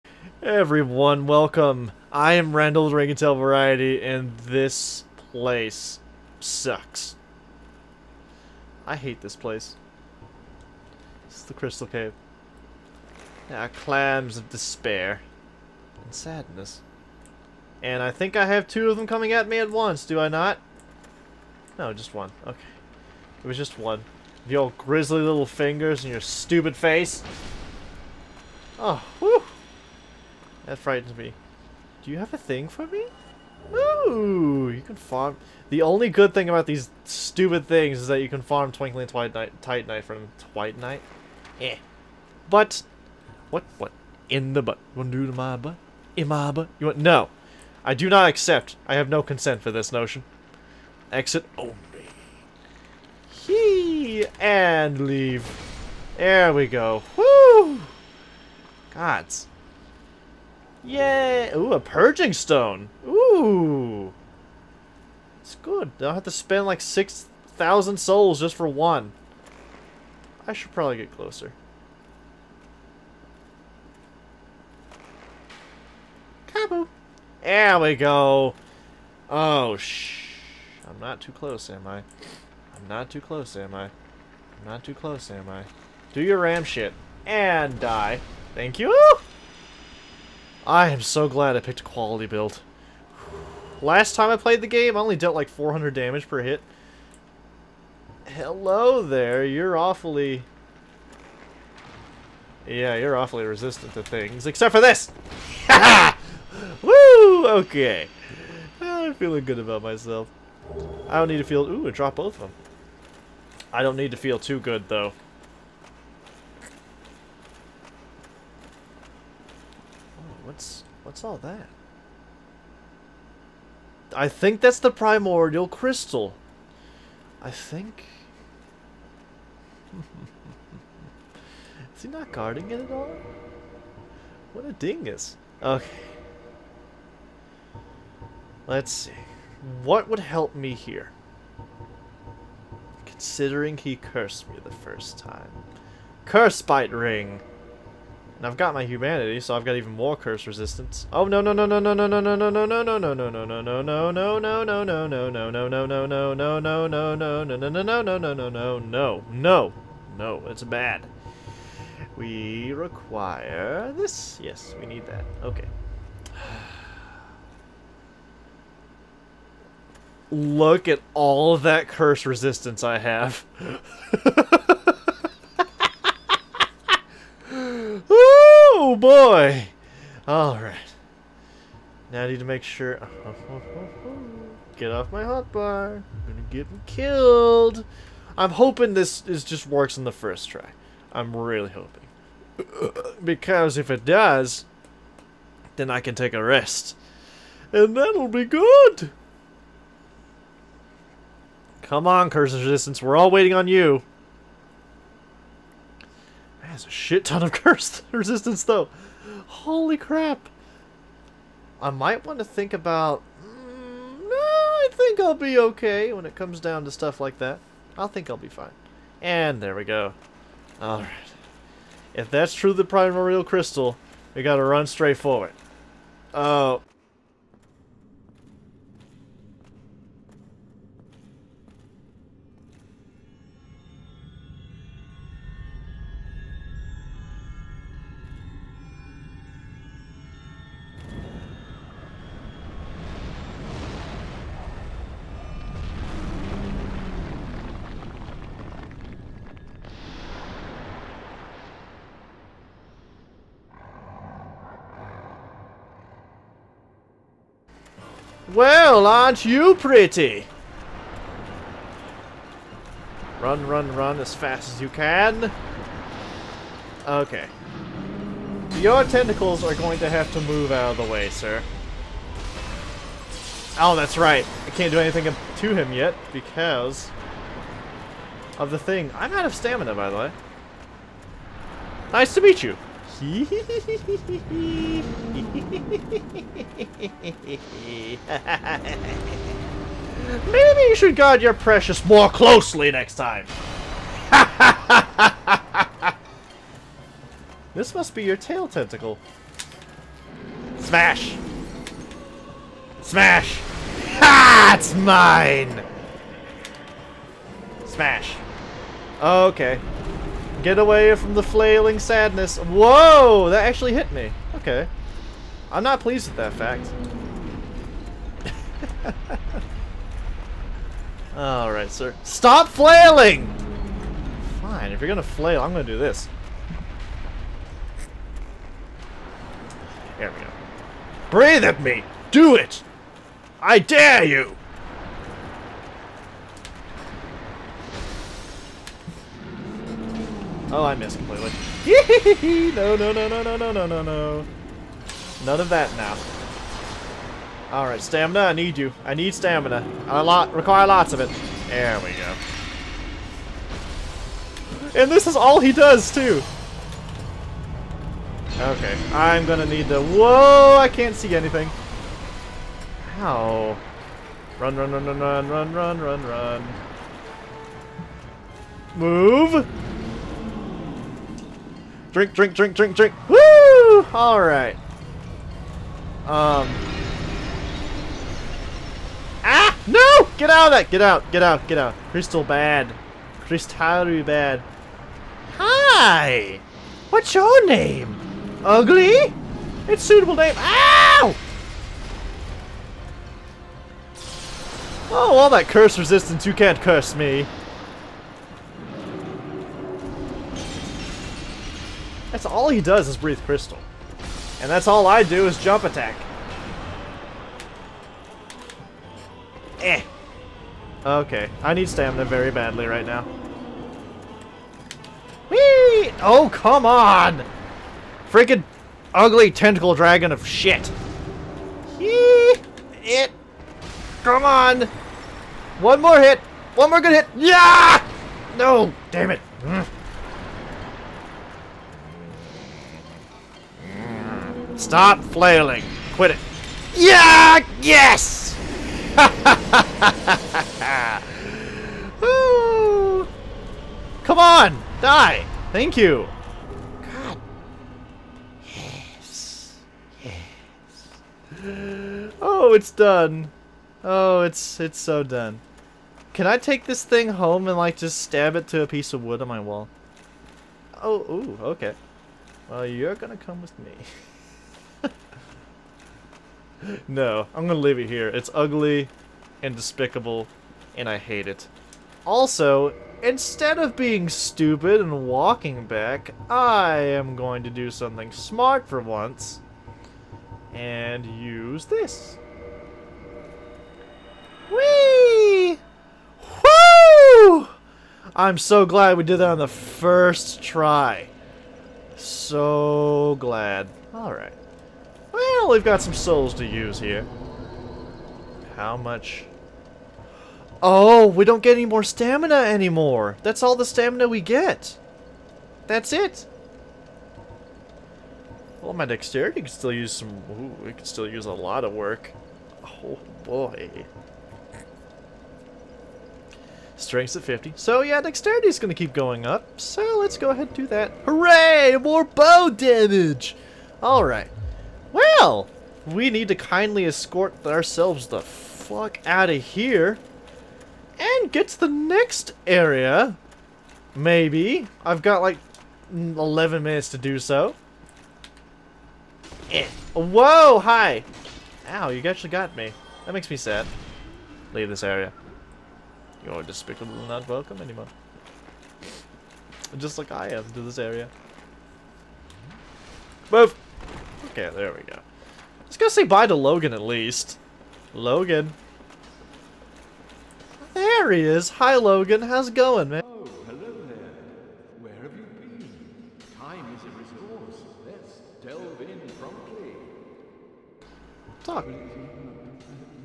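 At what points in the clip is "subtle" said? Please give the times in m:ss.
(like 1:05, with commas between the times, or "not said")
not said.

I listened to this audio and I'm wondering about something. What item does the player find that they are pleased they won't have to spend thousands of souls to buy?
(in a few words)
Purging stone.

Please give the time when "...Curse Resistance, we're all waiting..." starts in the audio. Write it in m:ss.
3:22.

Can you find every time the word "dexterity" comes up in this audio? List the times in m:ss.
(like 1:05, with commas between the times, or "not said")
8:29, 8:38.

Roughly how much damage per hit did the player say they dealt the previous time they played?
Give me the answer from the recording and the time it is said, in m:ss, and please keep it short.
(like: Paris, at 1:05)
400, at 1:35.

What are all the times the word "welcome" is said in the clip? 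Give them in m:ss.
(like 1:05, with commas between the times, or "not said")
0:01, 9:07.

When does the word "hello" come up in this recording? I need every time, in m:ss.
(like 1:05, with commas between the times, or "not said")
1:38, 9:23.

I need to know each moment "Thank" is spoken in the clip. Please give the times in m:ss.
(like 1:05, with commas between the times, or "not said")
1:28, 7:25.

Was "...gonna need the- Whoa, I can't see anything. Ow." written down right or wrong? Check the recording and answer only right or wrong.
right.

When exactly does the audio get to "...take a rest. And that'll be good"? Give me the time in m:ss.
3:16.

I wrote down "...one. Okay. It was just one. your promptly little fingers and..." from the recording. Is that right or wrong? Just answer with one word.
wrong.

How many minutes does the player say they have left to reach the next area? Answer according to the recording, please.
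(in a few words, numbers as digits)
11.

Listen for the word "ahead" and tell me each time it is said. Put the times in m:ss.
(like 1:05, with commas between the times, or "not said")
8:40.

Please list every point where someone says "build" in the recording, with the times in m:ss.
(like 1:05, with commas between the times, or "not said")
1:32.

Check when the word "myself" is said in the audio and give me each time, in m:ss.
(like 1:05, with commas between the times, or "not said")
1:49.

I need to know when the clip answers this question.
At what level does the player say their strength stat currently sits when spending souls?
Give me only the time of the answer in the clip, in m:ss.
8:37.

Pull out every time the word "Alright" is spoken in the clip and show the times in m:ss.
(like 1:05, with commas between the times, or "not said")
3:00, 3:40, 5:21, 5:47, 6:14, 8:14, 8:44.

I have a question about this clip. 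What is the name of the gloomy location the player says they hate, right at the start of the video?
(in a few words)
Crystal Cave.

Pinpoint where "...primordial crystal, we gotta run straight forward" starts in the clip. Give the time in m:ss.
3:42.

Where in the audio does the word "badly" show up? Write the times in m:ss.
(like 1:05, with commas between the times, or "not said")
6:52.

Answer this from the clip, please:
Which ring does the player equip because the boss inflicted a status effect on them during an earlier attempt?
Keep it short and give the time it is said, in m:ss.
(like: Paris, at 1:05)
Curse Bite Ring, at 2:26.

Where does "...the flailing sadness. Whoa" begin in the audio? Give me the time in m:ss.
5:11.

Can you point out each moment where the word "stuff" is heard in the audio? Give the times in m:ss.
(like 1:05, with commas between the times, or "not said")
3:36.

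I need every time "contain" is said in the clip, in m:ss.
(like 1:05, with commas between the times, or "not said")
not said.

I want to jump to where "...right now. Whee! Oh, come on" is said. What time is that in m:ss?
6:52.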